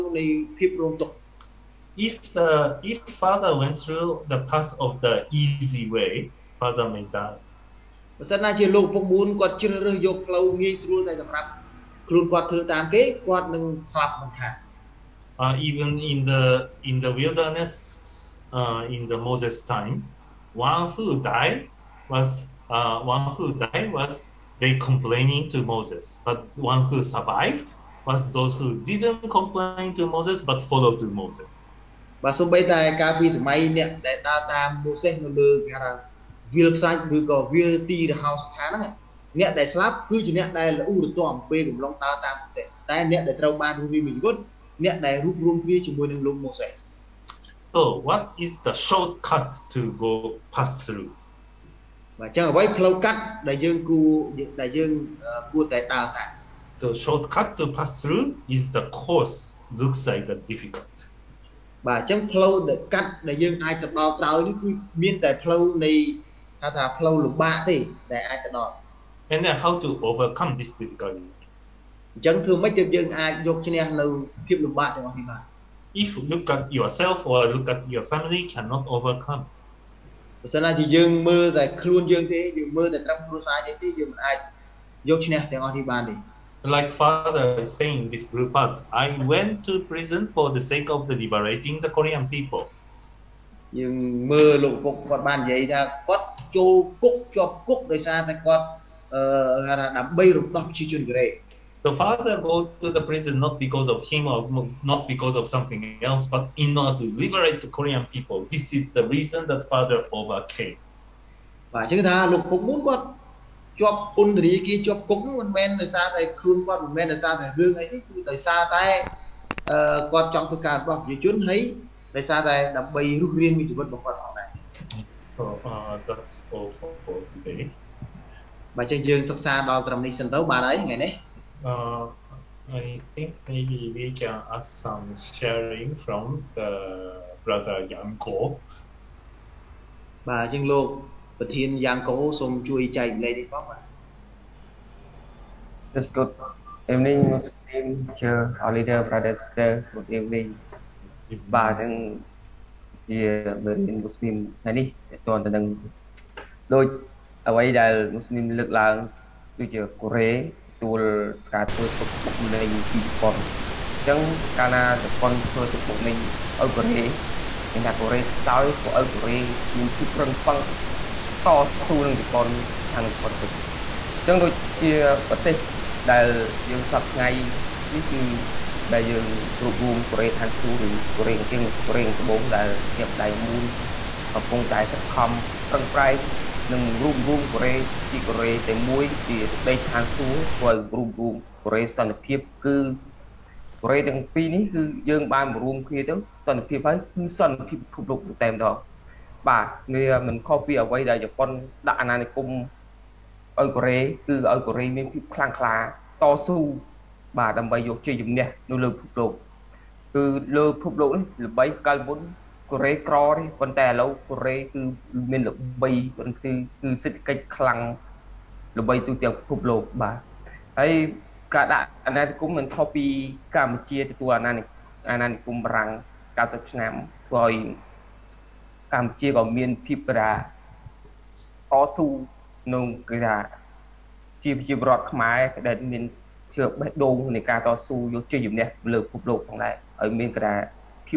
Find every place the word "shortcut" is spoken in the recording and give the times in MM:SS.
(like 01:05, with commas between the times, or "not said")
00:48, 00:56.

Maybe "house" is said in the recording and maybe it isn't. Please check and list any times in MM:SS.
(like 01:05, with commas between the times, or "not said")
00:32.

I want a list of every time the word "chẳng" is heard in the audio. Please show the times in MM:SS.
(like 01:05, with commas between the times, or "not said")
01:12.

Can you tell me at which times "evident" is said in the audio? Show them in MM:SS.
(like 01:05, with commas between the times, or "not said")
not said.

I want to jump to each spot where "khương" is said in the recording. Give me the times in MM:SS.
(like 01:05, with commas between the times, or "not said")
01:56.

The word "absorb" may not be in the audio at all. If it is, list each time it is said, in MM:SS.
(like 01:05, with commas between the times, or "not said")
not said.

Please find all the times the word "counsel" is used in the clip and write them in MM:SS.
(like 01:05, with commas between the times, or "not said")
not said.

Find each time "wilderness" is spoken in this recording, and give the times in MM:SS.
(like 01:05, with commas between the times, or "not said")
00:17.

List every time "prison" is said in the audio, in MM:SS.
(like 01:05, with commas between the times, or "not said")
01:29, 01:43.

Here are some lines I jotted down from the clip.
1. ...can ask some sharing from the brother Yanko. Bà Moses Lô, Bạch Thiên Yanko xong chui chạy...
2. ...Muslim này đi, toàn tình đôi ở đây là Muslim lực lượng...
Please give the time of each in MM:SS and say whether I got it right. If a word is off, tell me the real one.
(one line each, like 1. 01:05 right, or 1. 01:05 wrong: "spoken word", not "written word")
1. 02:14 wrong: "Trinh", not "Moses"
2. 02:34 right.